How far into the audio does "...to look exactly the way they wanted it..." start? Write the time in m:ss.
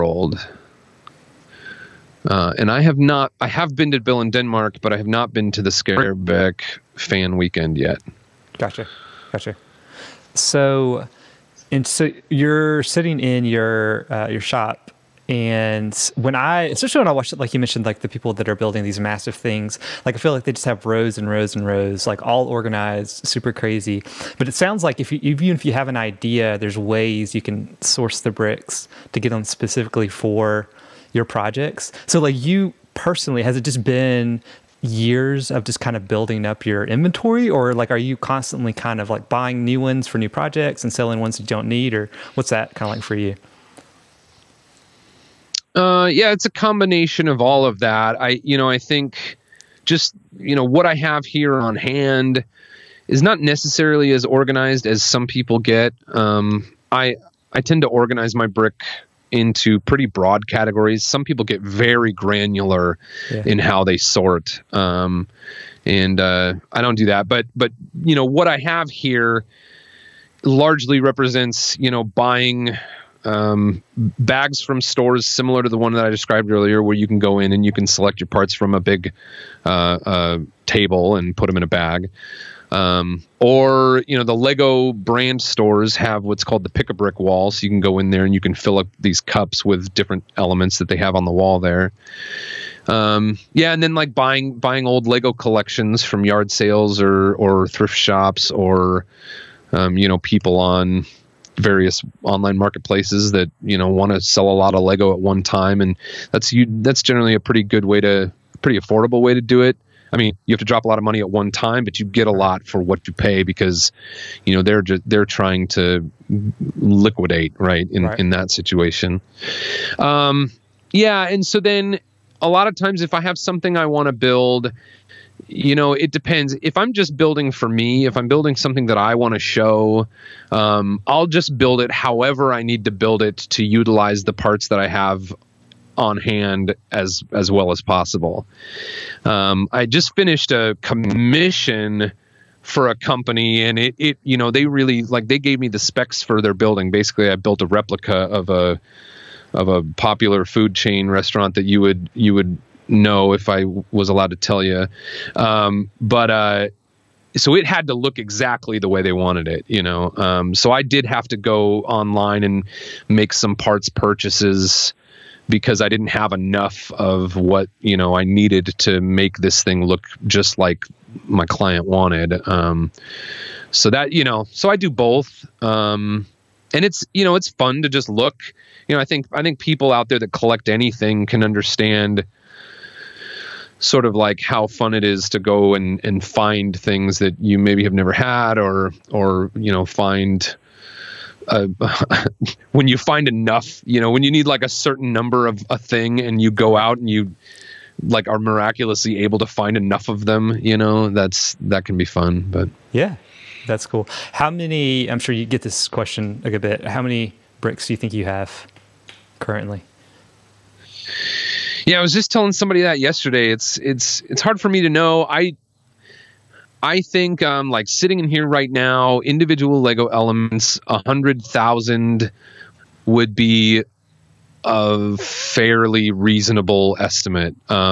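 2:37.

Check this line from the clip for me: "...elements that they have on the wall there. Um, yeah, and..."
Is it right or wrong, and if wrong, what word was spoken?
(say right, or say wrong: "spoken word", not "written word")
right.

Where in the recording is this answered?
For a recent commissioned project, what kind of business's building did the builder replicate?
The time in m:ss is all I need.
2:30.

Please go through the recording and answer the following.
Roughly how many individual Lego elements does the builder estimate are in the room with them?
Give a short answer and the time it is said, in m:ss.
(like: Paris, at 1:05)
100,000, at 3:40.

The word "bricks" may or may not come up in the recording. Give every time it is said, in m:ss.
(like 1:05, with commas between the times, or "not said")
0:28, 0:58, 1:26, 3:27.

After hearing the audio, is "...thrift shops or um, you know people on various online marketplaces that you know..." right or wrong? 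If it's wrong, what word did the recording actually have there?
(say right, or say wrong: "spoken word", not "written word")
right.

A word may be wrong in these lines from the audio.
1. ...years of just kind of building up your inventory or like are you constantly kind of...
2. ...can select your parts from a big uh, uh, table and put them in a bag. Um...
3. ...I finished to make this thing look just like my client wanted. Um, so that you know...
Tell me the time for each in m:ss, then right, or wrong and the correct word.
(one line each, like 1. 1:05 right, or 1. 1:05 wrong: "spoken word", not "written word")
1. 0:34 right
2. 1:17 right
3. 2:48 wrong: "needed", not "finished".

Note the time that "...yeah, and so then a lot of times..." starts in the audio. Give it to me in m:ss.
2:00.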